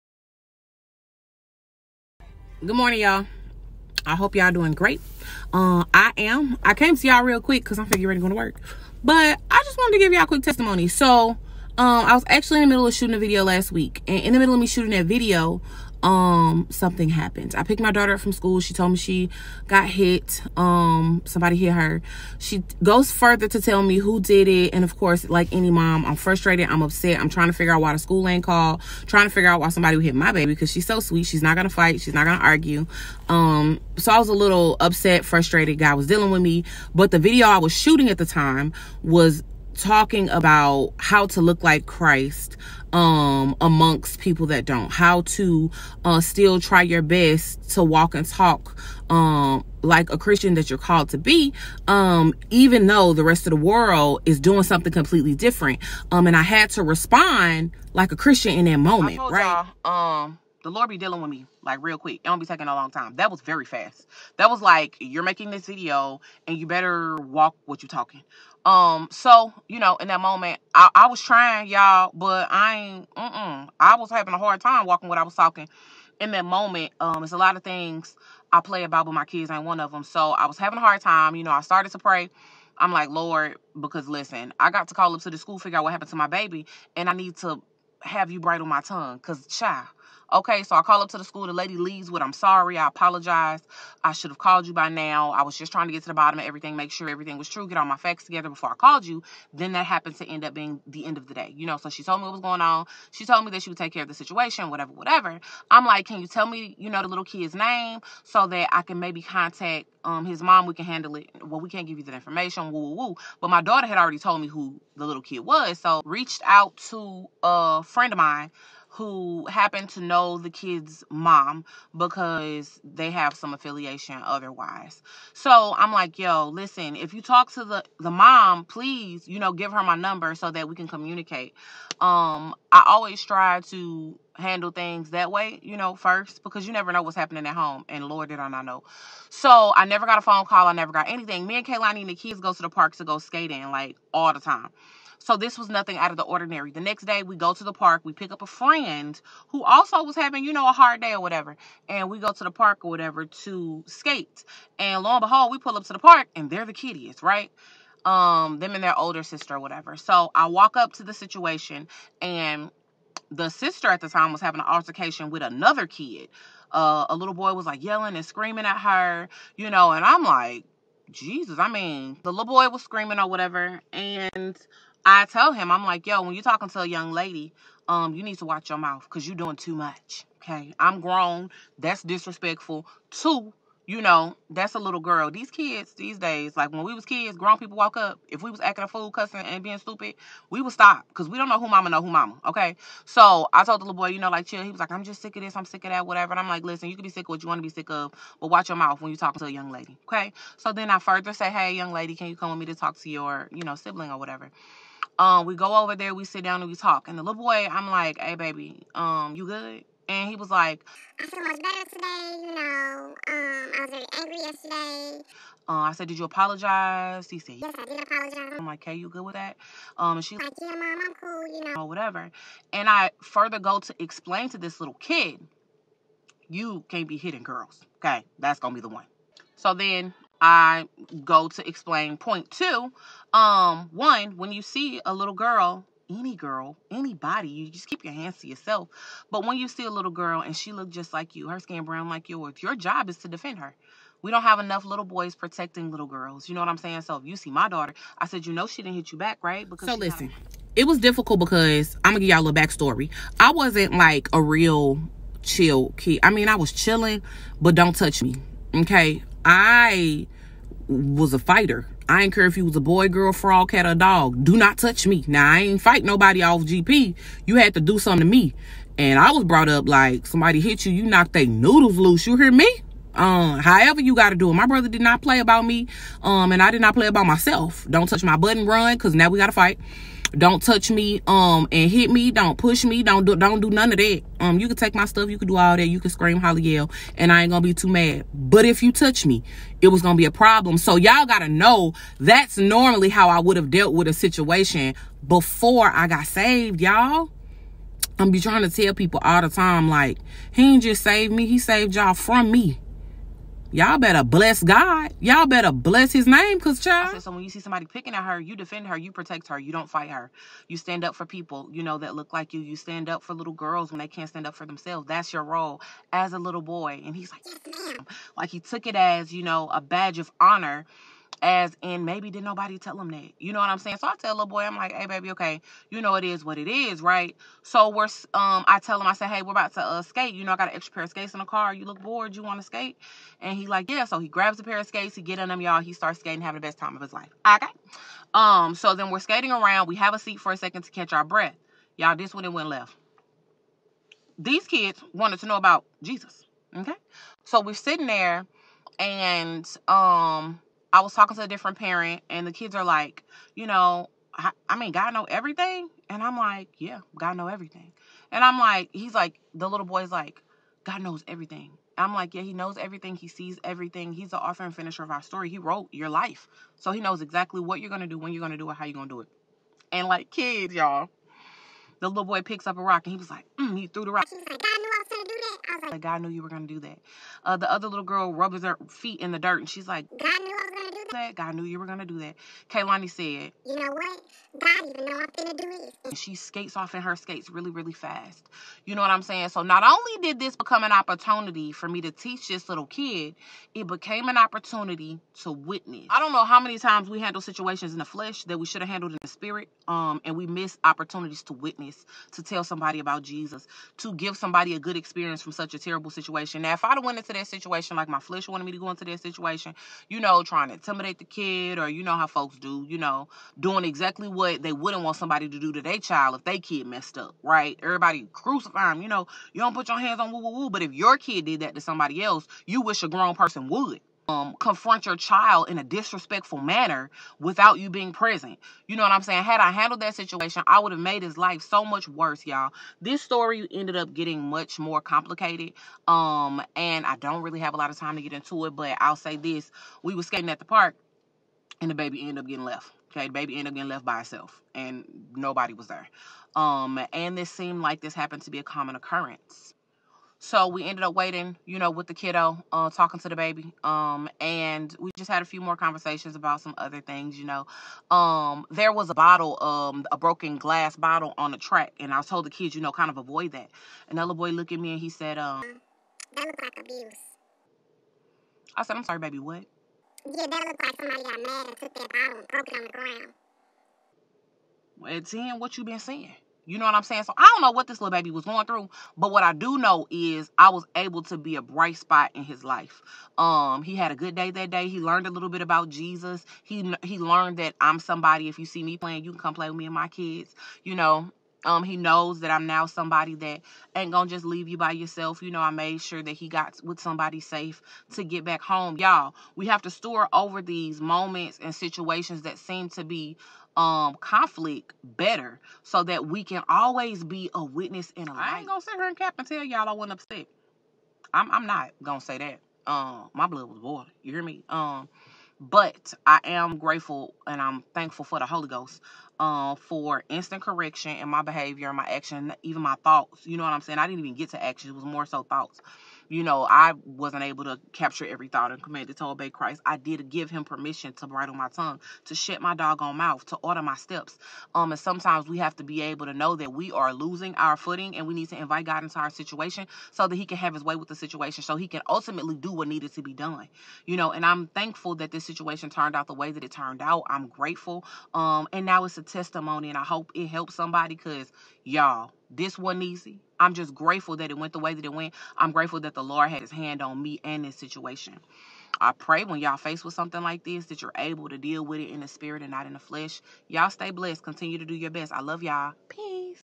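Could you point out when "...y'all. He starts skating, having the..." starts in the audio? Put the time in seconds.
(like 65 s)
335 s.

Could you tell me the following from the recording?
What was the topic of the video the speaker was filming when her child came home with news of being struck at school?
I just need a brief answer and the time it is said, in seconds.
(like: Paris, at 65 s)
How to look like Christ, at 40 s.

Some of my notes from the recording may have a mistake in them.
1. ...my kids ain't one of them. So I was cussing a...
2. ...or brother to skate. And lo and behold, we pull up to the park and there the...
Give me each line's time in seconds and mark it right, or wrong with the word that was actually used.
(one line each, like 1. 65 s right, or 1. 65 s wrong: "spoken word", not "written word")
1. 79 s wrong: "having", not "cussing"
2. 152 s wrong: "whatever", not "brother".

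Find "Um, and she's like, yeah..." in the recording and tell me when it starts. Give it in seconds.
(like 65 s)
219 s.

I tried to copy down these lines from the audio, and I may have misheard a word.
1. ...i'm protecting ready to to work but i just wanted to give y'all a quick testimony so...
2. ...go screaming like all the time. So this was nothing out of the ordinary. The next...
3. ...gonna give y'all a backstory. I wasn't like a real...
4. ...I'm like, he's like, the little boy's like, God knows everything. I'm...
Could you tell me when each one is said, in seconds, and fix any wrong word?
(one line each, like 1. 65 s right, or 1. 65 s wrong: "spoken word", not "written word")
1. 7 s wrong: "figuring", not "protecting"
2. 143 s wrong: "skating", not "screaming"
3. 252 s right
4. 358 s right.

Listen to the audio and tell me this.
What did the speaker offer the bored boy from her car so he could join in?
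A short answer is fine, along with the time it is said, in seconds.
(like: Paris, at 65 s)
An extra pair of skates, at 330 s.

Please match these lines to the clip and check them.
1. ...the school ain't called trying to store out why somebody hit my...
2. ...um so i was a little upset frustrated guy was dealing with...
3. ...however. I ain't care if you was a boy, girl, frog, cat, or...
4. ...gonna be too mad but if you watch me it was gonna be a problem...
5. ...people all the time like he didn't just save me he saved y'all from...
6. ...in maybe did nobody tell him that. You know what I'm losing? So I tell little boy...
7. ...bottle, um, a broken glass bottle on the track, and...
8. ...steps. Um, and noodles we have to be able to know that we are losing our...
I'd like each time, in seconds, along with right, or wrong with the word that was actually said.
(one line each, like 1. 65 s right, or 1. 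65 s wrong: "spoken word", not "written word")
1. 27 s wrong: "figure", not "store"
2. 33 s right
3. 261 s wrong: "fighter", not "however"
4. 287 s wrong: "touch", not "watch"
5. 298 s right
6. 321 s wrong: "saying", not "losing"
7. 459 s right
8. 533 s wrong: "sometimes", not "noodles".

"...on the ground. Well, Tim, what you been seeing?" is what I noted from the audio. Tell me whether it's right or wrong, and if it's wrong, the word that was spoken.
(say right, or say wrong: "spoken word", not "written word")
right.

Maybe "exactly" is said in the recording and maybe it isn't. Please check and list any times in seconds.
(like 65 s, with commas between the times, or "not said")
367 s, 413 s.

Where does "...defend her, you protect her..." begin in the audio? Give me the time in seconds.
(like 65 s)
308 s.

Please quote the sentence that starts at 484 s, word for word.
He learned a little bit about Jesus.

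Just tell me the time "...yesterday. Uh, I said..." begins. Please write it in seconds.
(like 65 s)
214 s.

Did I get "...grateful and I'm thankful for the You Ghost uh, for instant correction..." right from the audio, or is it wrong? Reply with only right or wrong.
wrong.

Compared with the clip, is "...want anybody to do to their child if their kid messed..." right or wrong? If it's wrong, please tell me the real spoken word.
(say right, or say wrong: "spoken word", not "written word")
wrong: "somebody", not "anybody".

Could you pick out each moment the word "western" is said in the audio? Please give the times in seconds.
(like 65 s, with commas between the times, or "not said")
not said.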